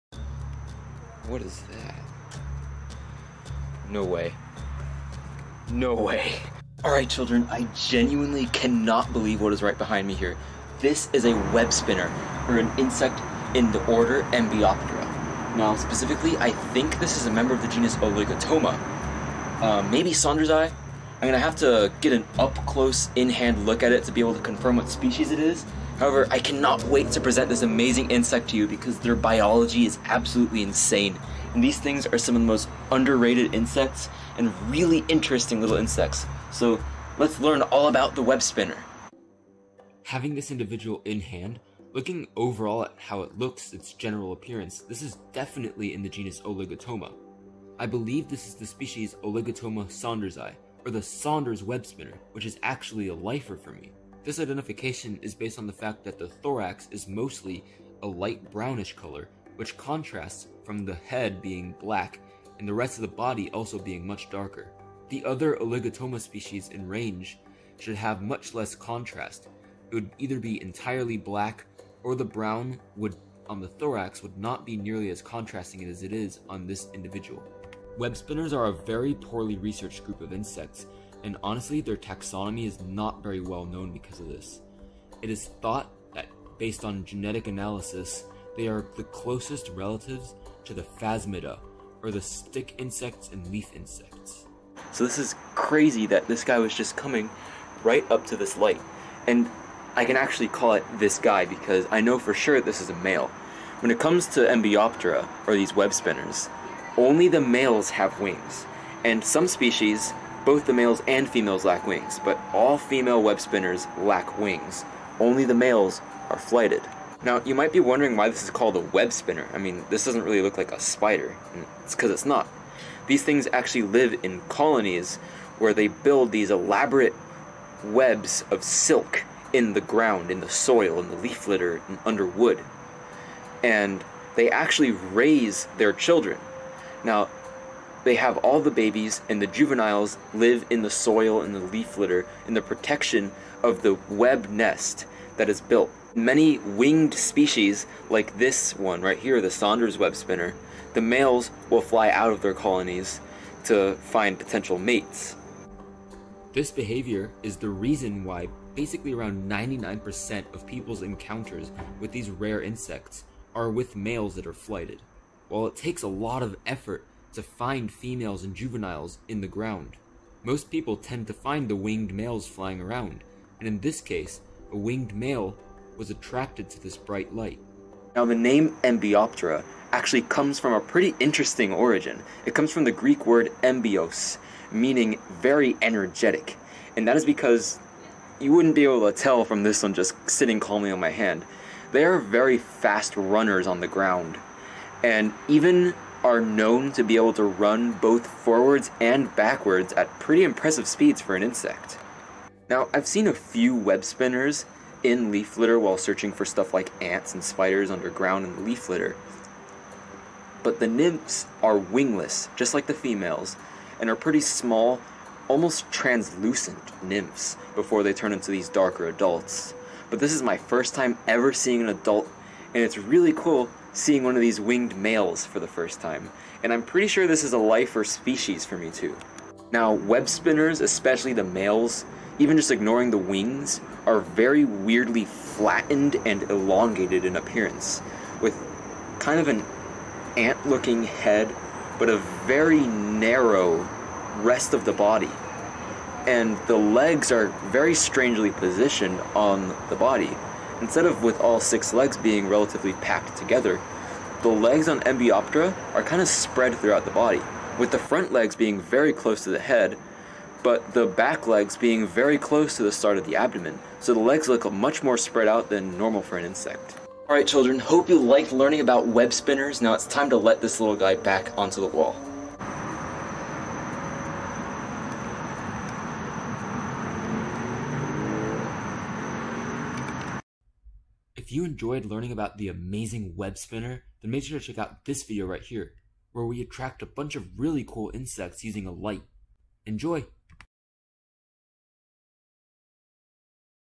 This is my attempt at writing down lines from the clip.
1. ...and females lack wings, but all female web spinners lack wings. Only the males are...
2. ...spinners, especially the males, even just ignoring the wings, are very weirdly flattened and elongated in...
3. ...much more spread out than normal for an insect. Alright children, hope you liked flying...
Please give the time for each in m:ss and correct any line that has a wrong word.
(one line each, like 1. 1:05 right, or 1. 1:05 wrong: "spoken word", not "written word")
1. 1:51 right
2. 3:50 right
3. 4:24 wrong: "learning", not "flying".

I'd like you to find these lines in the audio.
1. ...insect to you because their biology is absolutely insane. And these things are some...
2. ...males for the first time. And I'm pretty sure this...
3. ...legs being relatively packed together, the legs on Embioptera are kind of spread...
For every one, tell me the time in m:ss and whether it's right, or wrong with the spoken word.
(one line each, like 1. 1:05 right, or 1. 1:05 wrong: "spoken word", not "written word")
1. 0:28 right
2. 3:44 right
3. 4:11 right.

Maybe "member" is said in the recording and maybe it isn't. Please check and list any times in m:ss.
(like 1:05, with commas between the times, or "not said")
0:17.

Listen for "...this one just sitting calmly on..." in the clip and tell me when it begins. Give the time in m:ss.
3:09.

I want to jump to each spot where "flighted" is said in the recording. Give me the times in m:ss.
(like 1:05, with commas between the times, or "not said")
1:56, 2:44.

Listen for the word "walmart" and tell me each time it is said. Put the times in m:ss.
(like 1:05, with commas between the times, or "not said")
not said.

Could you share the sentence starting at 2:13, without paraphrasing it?
And they actually raise their children.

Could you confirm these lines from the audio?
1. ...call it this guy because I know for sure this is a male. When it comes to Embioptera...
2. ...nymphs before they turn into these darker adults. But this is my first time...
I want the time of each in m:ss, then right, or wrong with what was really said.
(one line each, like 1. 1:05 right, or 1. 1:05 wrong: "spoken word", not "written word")
1. 1:40 right
2. 3:37 right.